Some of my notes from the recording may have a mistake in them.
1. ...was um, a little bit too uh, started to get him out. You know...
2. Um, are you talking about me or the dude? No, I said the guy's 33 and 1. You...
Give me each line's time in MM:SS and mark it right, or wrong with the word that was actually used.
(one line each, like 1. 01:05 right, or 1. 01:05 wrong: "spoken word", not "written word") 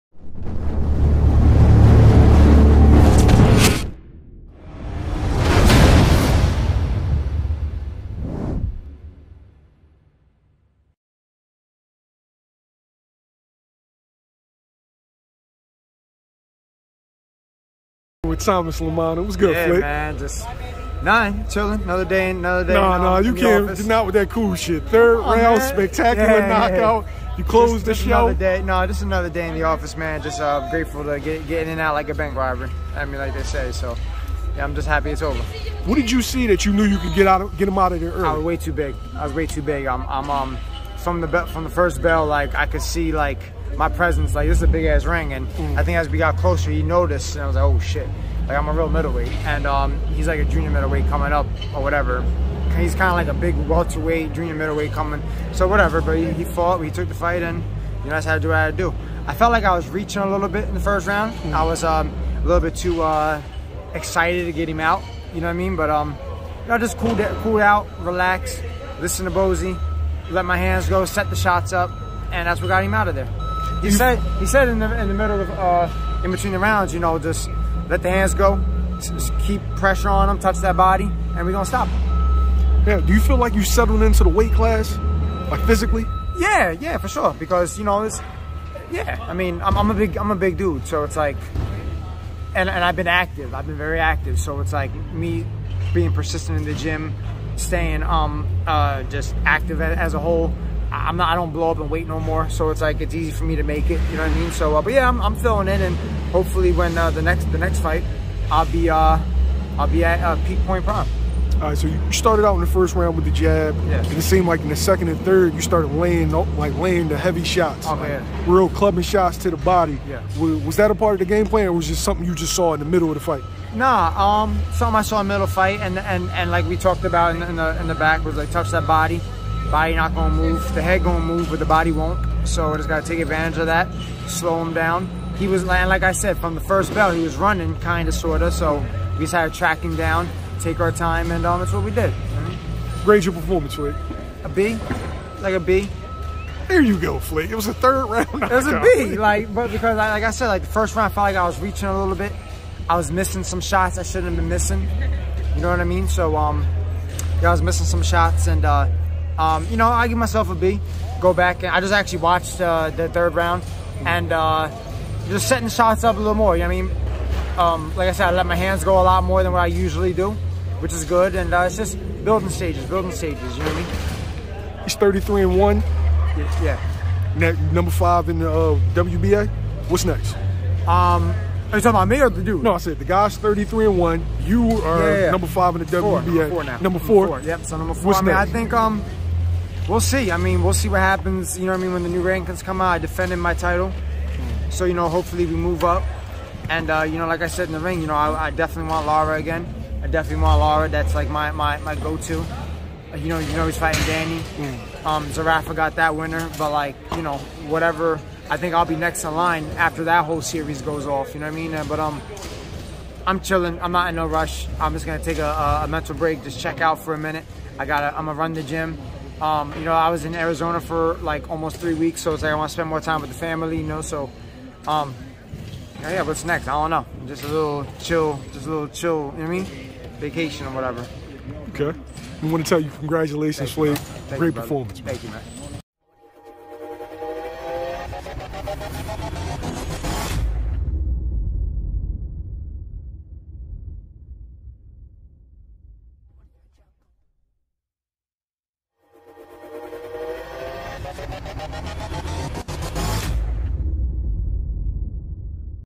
1. 01:01 wrong: "excited", not "started"
2. 03:00 right.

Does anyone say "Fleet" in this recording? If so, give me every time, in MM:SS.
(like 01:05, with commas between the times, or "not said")
02:27.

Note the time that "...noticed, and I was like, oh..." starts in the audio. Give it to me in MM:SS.
00:46.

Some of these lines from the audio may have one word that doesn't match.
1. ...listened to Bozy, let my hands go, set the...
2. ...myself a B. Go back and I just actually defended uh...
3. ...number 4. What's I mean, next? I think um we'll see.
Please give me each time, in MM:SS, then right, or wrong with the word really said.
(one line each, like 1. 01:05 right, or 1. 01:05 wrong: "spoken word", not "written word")
1. 01:08 right
2. 02:40 wrong: "watched", not "defended"
3. 03:07 right.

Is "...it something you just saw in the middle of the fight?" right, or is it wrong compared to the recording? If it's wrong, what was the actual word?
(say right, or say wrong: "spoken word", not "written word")
right.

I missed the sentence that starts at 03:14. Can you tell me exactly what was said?
So, you know, hopefully we move up.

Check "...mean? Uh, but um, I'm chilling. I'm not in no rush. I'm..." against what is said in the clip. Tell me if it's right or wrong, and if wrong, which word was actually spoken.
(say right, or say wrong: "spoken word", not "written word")
right.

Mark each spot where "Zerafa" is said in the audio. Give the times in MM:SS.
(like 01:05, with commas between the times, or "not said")
03:25.